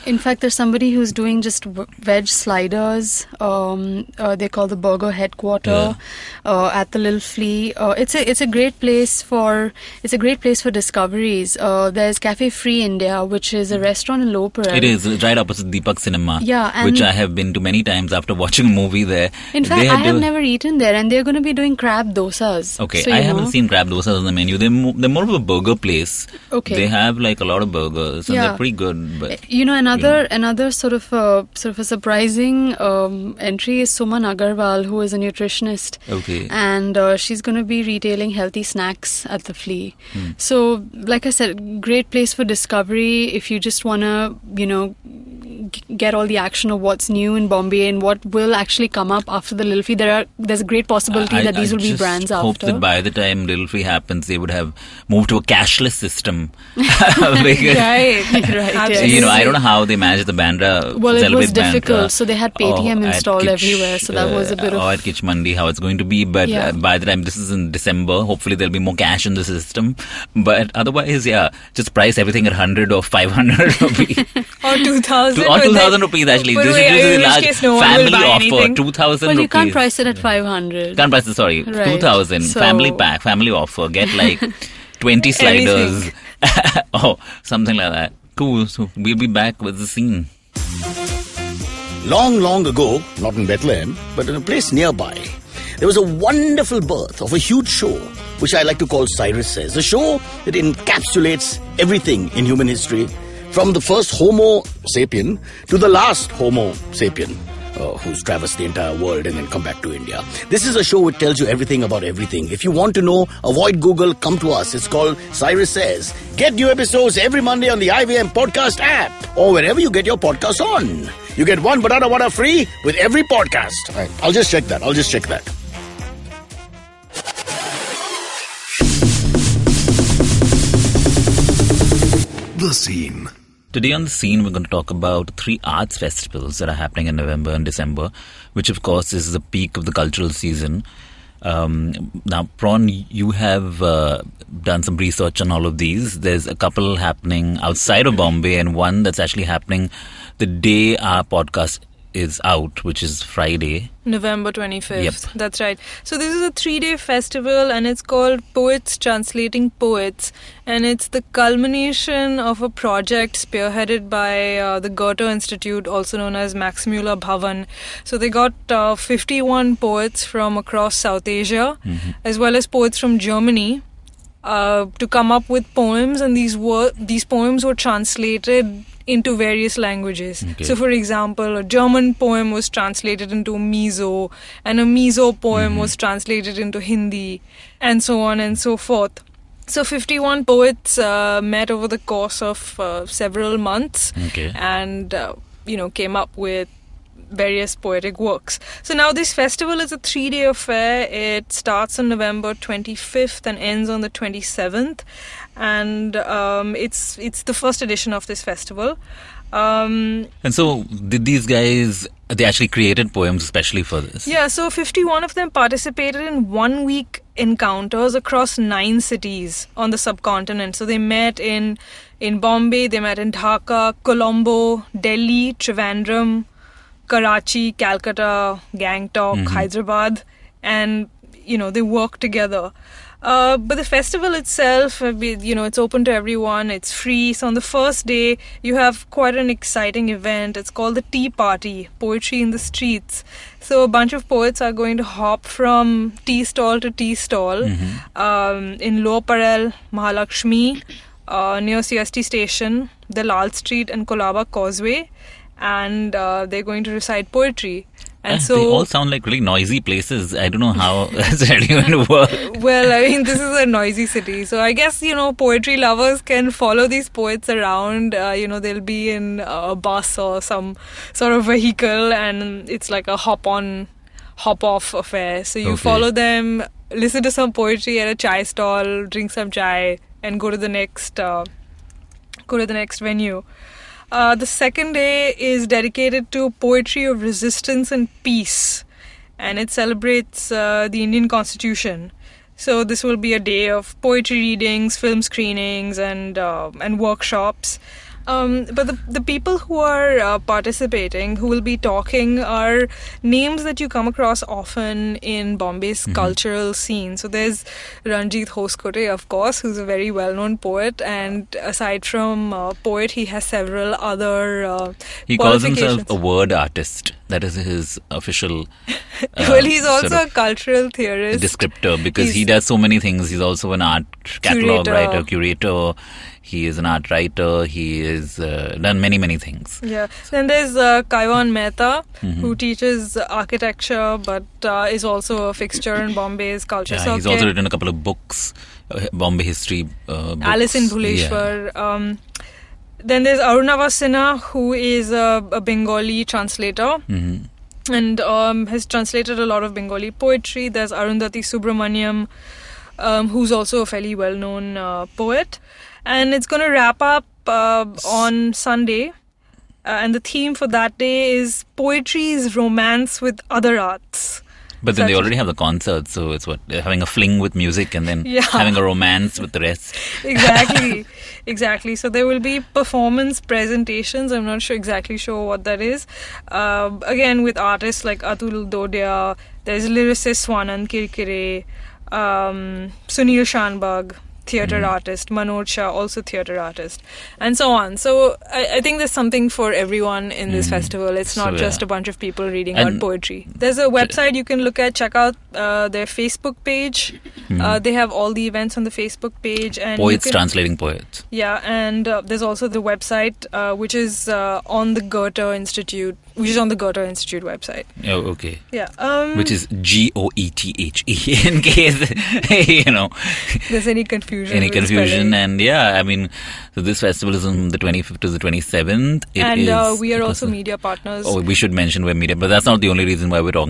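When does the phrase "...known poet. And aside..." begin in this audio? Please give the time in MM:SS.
05:10.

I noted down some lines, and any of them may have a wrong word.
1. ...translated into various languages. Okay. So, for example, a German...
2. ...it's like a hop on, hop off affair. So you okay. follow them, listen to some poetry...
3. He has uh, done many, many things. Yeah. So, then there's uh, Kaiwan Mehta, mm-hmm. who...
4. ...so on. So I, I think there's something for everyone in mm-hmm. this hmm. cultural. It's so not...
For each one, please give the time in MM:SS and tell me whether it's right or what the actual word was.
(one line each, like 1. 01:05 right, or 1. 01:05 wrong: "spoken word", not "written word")
1. 02:57 right
2. 04:32 right
3. 05:27 right
4. 06:27 wrong: "festival", not "cultural".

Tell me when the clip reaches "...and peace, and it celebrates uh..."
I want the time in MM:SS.
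04:47.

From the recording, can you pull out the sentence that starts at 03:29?
Um, and so, did these guys?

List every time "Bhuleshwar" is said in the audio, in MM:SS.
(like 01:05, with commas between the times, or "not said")
05:40.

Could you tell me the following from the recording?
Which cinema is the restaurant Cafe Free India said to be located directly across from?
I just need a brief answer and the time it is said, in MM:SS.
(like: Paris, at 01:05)
Deepak Cinema, at 00:15.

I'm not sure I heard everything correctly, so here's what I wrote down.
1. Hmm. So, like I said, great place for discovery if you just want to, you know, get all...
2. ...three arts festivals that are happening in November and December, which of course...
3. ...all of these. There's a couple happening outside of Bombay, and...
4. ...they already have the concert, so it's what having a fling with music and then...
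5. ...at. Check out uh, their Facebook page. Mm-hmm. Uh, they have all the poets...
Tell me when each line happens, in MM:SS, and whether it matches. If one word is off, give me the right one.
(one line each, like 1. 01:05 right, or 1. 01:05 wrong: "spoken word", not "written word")
1. 00:40 right
2. 02:15 right
3. 02:25 right
4. 06:05 right
5. 06:34 wrong: "events", not "poets".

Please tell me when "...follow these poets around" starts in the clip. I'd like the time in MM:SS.
04:26.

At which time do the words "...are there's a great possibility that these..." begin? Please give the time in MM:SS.
00:50.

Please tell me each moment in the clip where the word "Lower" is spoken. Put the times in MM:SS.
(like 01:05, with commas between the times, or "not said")
00:14, 04:09.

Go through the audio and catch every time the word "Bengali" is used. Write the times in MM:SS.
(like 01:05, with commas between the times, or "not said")
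05:45, 05:49.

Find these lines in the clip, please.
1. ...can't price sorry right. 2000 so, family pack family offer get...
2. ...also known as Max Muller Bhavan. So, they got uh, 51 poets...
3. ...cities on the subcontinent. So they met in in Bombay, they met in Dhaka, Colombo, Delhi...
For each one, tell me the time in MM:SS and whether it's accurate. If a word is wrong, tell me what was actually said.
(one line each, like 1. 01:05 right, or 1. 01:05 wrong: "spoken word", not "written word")
1. 01:20 right
2. 02:45 right
3. 03:39 right.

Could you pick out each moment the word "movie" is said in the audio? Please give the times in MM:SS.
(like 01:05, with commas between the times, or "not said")
00:18.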